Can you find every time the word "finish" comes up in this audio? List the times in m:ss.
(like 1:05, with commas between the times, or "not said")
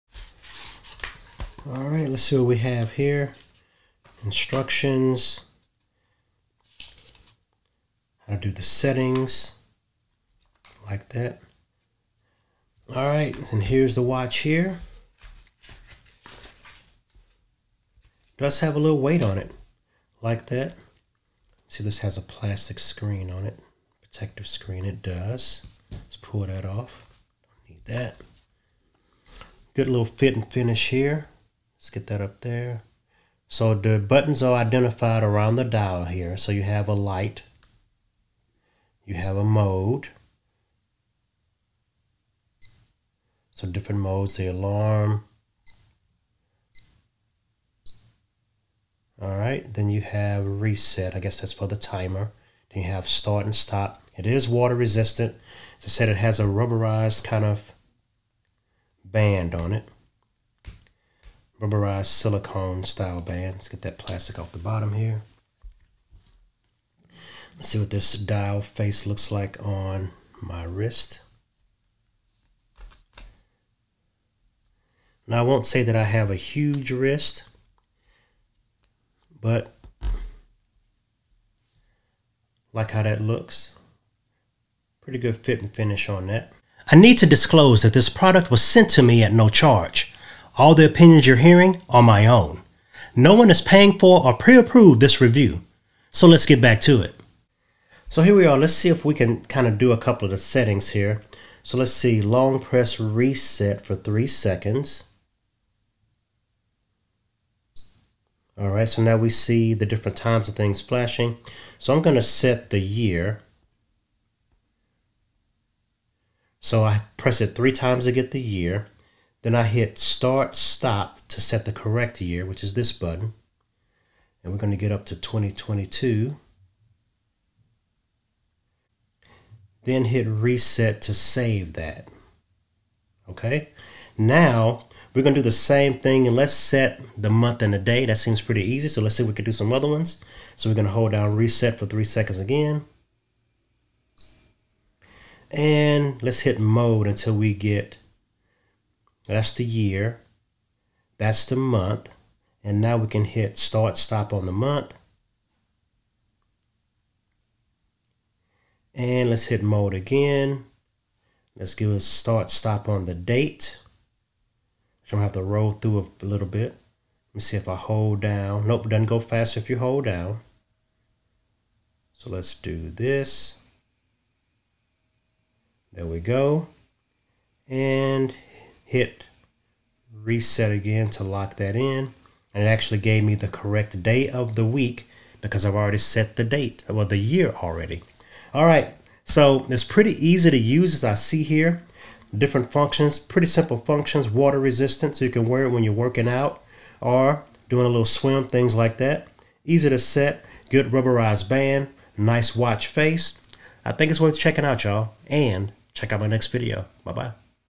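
0:30, 1:25.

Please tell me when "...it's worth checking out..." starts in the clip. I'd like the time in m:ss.
3:24.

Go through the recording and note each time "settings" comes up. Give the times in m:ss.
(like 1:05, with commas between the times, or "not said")
0:08, 1:40.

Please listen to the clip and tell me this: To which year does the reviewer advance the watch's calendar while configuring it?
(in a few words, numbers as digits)
2022.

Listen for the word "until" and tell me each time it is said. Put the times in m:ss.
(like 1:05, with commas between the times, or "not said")
2:27.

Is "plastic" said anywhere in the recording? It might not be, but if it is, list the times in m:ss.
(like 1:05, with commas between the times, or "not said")
0:22, 1:03.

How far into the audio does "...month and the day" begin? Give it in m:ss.
2:17.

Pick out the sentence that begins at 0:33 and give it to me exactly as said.
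So the buttons are identified around the dial here.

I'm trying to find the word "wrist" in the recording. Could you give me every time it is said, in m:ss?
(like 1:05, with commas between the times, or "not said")
1:10, 1:16.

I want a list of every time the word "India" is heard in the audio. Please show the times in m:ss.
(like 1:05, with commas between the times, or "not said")
not said.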